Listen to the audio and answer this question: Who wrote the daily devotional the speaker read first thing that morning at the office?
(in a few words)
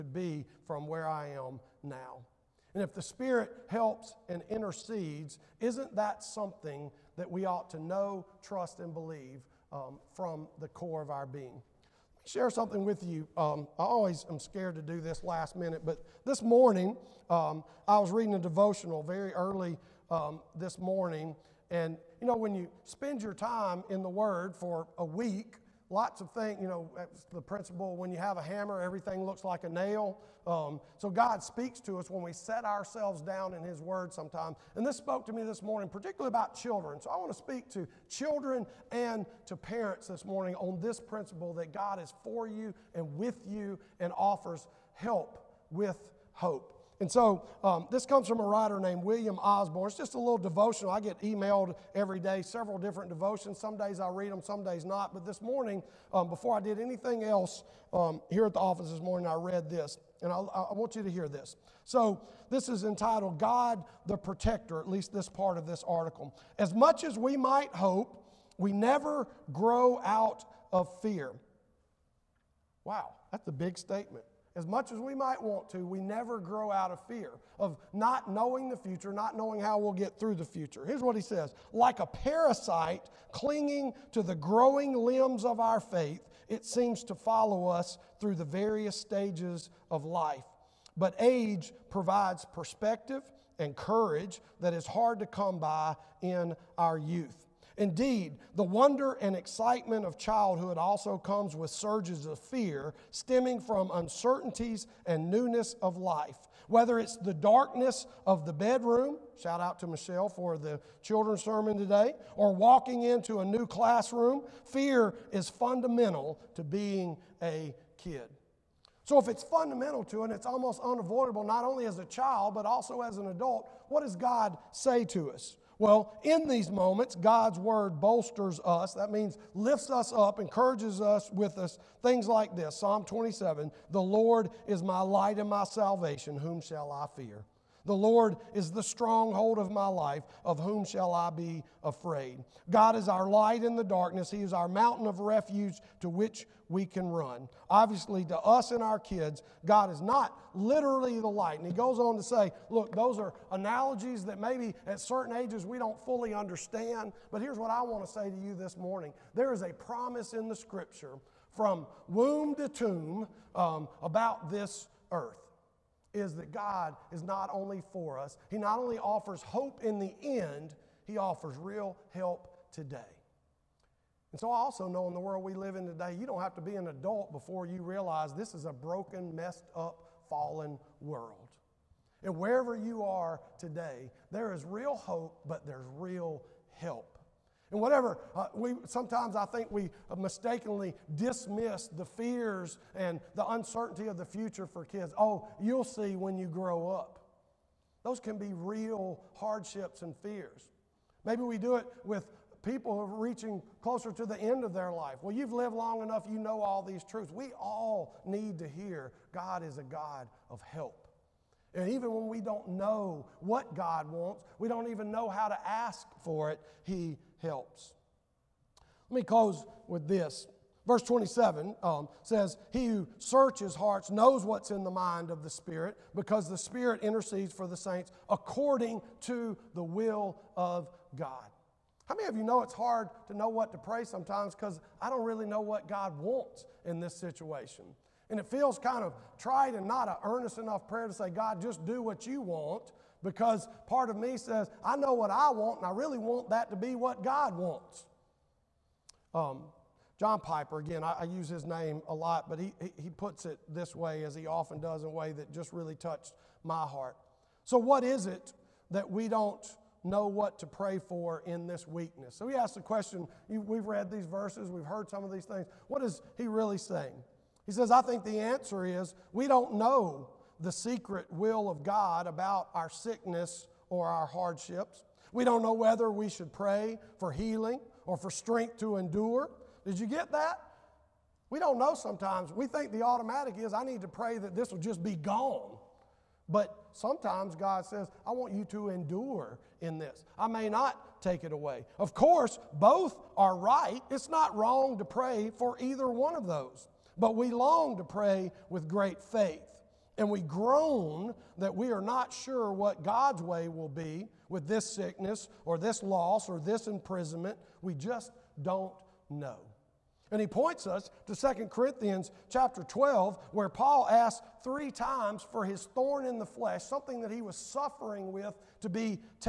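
William Osborne.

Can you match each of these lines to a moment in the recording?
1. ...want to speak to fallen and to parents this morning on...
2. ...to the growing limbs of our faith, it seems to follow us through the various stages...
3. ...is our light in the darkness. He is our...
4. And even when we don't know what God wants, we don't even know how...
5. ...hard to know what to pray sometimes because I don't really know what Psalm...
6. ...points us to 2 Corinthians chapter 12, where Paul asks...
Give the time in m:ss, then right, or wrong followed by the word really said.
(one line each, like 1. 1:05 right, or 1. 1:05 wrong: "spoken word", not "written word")
1. 0:37 wrong: "children", not "fallen"
2. 1:24 right
3. 2:22 right
4. 3:31 right
5. 3:52 wrong: "God", not "Psalm"
6. 5:10 right.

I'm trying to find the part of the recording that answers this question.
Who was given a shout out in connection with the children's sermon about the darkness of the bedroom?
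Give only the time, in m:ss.
1:49.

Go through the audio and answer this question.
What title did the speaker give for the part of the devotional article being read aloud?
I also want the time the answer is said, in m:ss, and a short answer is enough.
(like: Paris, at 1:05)
God the Protector, at 1:03.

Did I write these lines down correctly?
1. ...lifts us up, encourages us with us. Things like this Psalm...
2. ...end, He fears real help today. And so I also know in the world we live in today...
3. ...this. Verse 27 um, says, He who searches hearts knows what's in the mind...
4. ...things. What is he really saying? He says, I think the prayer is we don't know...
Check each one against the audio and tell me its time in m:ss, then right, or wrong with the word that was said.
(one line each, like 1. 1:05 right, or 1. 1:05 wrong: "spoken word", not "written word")
1. 2:09 right
2. 2:50 wrong: "offers", not "fears"
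3. 3:40 right
4. 4:25 wrong: "answer", not "prayer".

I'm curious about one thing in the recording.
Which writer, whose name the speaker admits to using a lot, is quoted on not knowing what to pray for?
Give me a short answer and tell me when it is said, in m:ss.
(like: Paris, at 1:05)
John Piper, at 4:10.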